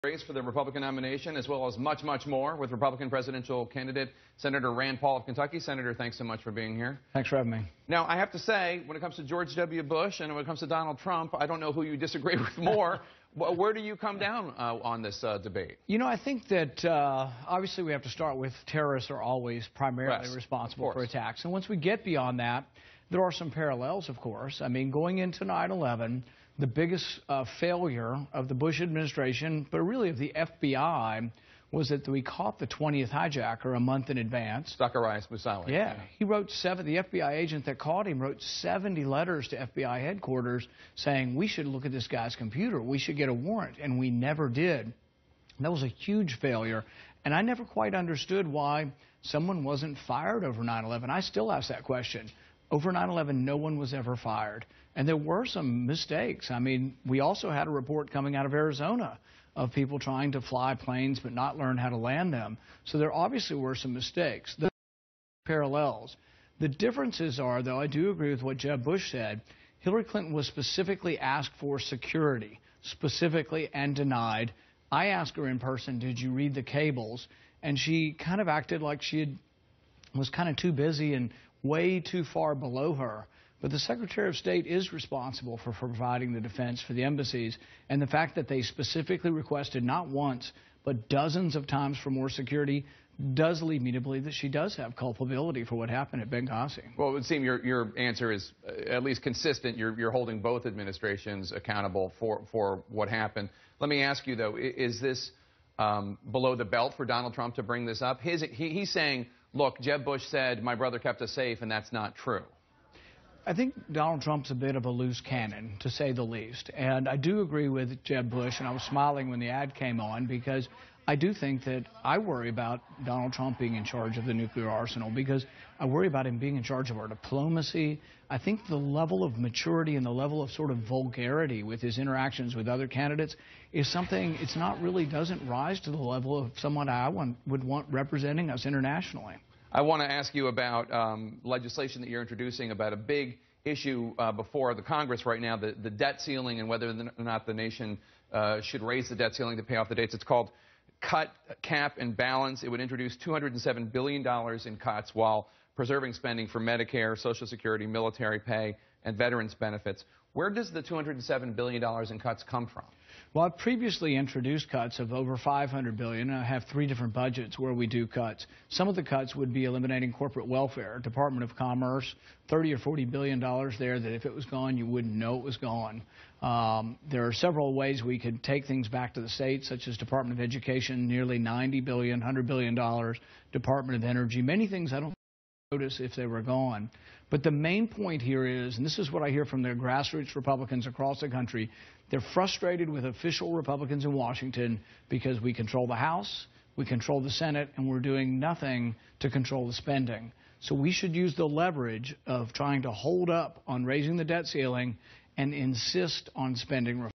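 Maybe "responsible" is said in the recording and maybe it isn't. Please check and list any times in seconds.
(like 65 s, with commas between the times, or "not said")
20 s, 84 s.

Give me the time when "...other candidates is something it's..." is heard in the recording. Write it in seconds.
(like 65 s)
132 s.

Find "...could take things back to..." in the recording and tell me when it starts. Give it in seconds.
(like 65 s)
178 s.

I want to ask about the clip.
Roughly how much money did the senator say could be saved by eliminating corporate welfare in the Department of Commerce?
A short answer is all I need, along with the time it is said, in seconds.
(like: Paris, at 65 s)
30 or 40 billion dollars, at 172 s.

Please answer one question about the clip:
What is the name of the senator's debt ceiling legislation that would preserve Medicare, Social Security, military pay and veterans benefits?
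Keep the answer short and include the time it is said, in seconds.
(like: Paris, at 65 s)
Cut, cap, and balance, at 151 s.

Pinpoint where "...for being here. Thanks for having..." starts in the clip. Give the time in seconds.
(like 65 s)
6 s.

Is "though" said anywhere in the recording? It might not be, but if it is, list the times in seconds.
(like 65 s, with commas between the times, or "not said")
67 s, 104 s.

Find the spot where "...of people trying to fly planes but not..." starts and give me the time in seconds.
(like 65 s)
59 s.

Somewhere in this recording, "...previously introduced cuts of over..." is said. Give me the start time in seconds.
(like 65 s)
163 s.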